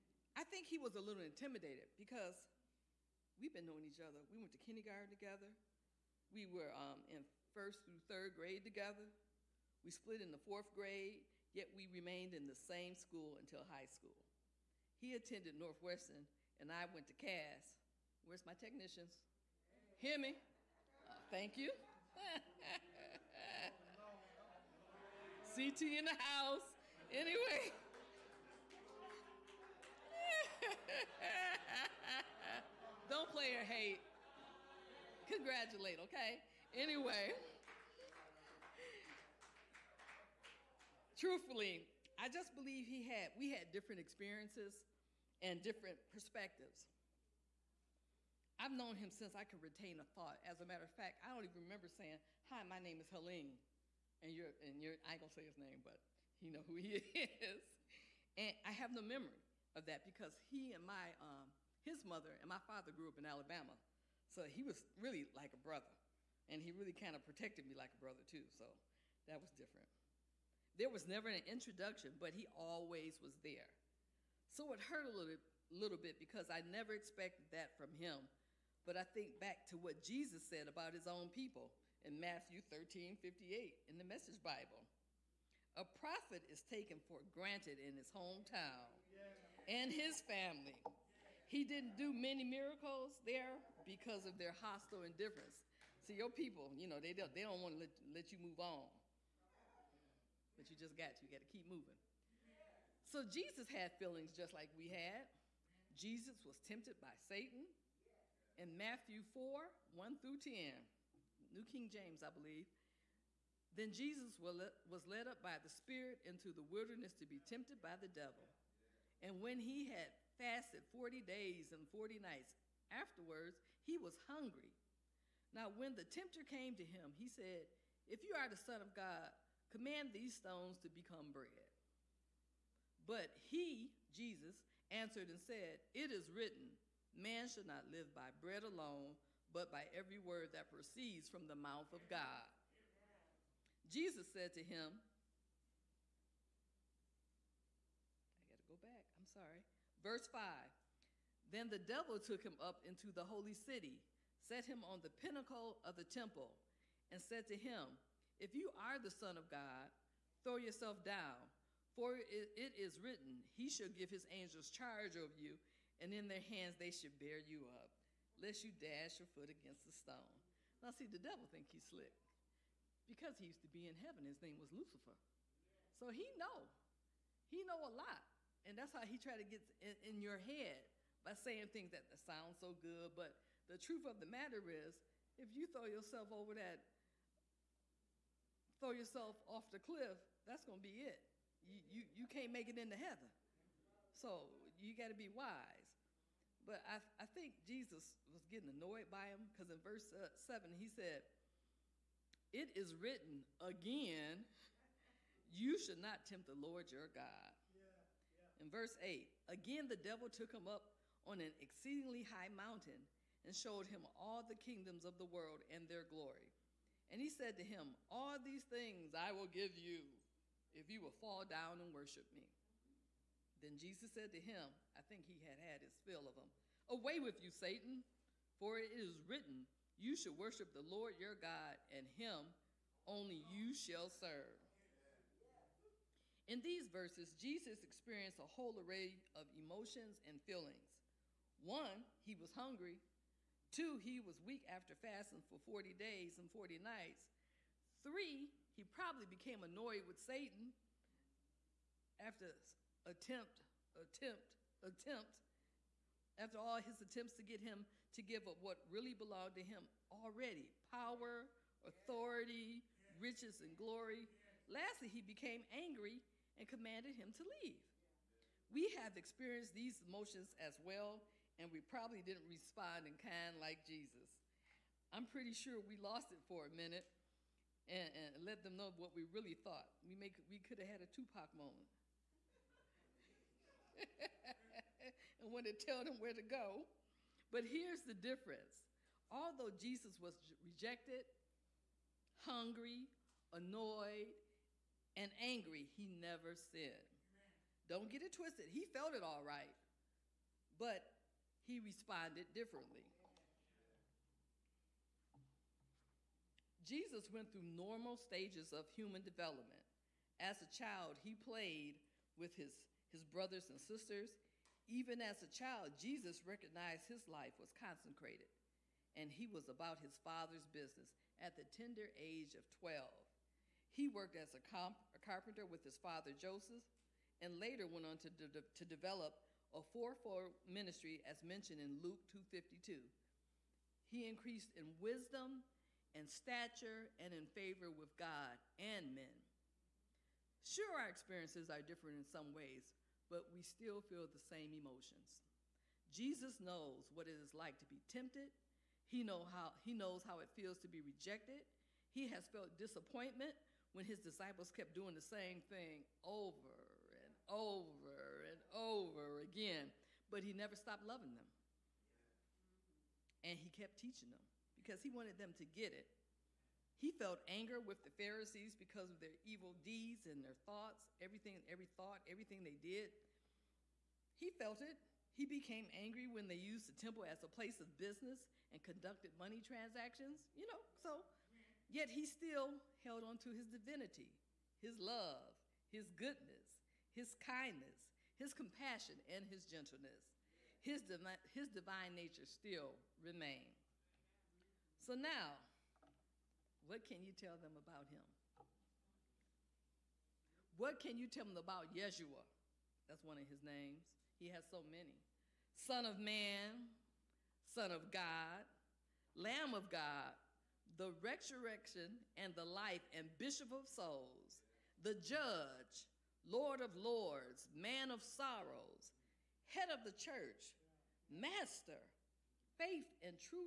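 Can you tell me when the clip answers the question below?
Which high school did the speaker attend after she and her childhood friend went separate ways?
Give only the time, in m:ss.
0:17.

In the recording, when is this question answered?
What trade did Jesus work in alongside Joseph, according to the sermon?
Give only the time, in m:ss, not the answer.
5:25.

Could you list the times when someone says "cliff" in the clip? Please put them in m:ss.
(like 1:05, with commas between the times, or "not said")
3:09.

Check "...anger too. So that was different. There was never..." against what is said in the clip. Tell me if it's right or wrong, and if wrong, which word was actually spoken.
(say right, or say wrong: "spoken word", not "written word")
wrong: "brother", not "anger".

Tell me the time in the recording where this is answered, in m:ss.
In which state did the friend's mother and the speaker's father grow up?
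1:03.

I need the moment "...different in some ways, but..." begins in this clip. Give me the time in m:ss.
5:41.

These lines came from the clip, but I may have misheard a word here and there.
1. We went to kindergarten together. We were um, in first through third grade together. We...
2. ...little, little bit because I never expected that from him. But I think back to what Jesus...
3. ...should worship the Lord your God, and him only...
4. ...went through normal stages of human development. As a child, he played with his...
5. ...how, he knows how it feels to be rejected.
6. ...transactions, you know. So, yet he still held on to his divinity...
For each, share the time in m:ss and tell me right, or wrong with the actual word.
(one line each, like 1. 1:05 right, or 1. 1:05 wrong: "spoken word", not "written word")
1. 0:04 right
2. 1:15 right
3. 3:50 right
4. 5:07 right
5. 5:49 right
6. 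6:19 right.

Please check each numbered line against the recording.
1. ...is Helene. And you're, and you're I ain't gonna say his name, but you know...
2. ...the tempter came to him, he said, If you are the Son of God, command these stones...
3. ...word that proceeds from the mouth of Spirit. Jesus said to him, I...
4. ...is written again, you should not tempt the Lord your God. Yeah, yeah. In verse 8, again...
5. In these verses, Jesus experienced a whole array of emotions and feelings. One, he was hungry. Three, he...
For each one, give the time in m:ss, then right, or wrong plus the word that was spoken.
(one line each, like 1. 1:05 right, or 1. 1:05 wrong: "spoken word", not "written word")
1. 0:53 right
2. 2:05 right
3. 2:20 wrong: "God", not "Spirit"
4. 3:22 right
5. 3:56 wrong: "Two", not "Three".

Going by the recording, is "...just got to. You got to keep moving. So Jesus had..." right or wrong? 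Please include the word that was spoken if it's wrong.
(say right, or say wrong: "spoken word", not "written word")
right.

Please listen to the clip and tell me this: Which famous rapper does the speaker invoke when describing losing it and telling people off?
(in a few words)
Tupac.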